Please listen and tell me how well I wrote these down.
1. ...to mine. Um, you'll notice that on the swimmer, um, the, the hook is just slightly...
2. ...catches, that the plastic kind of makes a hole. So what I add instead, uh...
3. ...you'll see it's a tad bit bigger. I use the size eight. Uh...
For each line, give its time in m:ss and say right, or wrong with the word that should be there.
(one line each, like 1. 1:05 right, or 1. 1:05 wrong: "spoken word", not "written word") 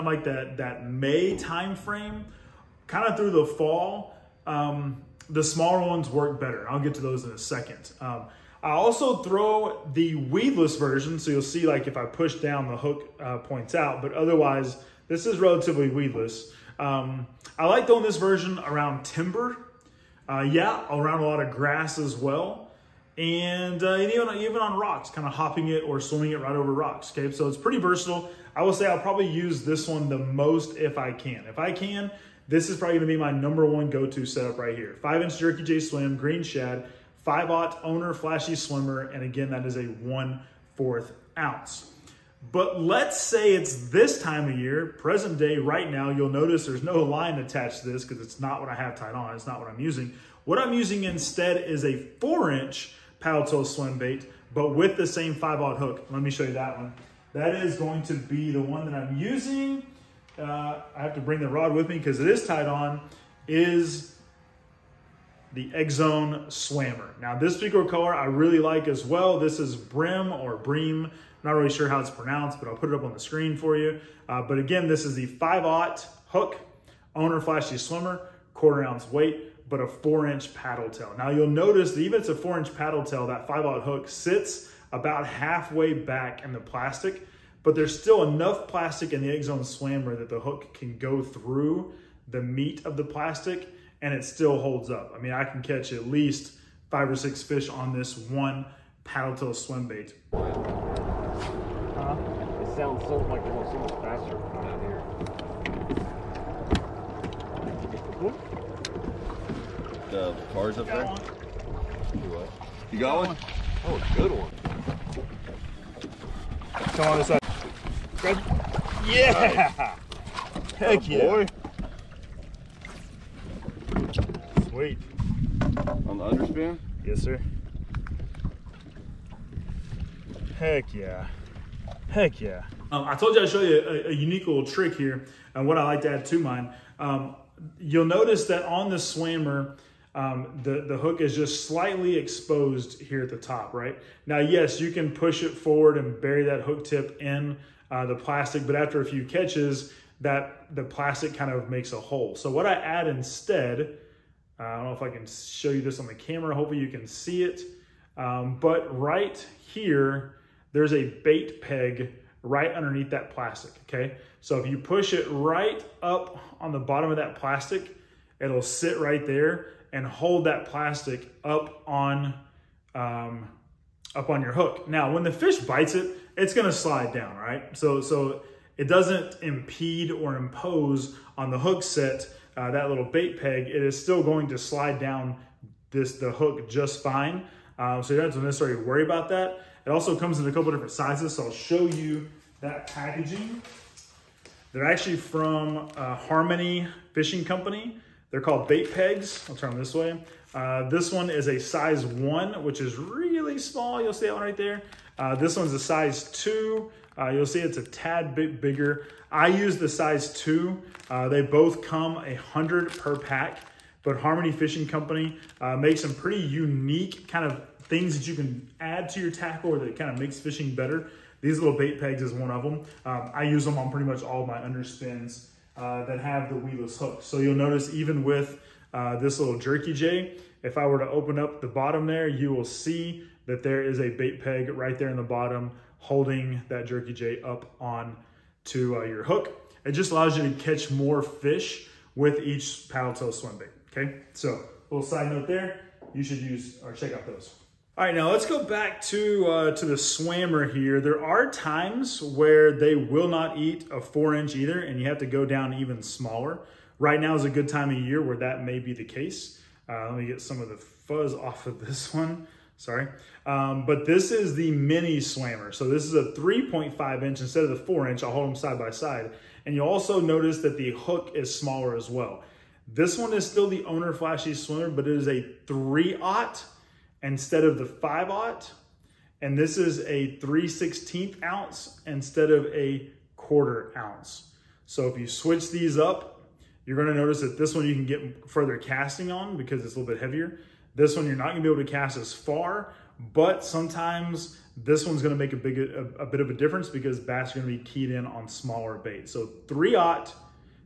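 1. 2:16 right
2. 2:29 right
3. 3:27 wrong: "two", not "eight".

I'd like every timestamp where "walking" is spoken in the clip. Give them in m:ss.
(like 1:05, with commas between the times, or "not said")
not said.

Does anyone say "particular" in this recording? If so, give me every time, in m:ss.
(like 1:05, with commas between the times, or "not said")
1:07.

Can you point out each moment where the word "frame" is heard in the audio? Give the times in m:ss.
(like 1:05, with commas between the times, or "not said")
0:01.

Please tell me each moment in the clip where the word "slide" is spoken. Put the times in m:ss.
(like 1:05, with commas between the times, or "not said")
2:56, 3:04.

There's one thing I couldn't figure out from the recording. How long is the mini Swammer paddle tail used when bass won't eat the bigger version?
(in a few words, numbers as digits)
3.5 inches.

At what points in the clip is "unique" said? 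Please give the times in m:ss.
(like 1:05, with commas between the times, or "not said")
2:14, 3:36.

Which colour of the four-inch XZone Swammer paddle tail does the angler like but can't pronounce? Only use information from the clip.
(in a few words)
Bream.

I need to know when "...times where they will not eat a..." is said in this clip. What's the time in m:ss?
4:11.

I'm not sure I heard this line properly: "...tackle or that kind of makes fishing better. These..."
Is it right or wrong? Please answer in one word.
right.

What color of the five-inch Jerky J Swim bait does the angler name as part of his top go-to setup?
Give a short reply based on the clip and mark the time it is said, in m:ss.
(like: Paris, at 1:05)
Green Shad, at 0:36.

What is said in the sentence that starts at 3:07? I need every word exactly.
Uh, so you don't have to necessarily worry about that.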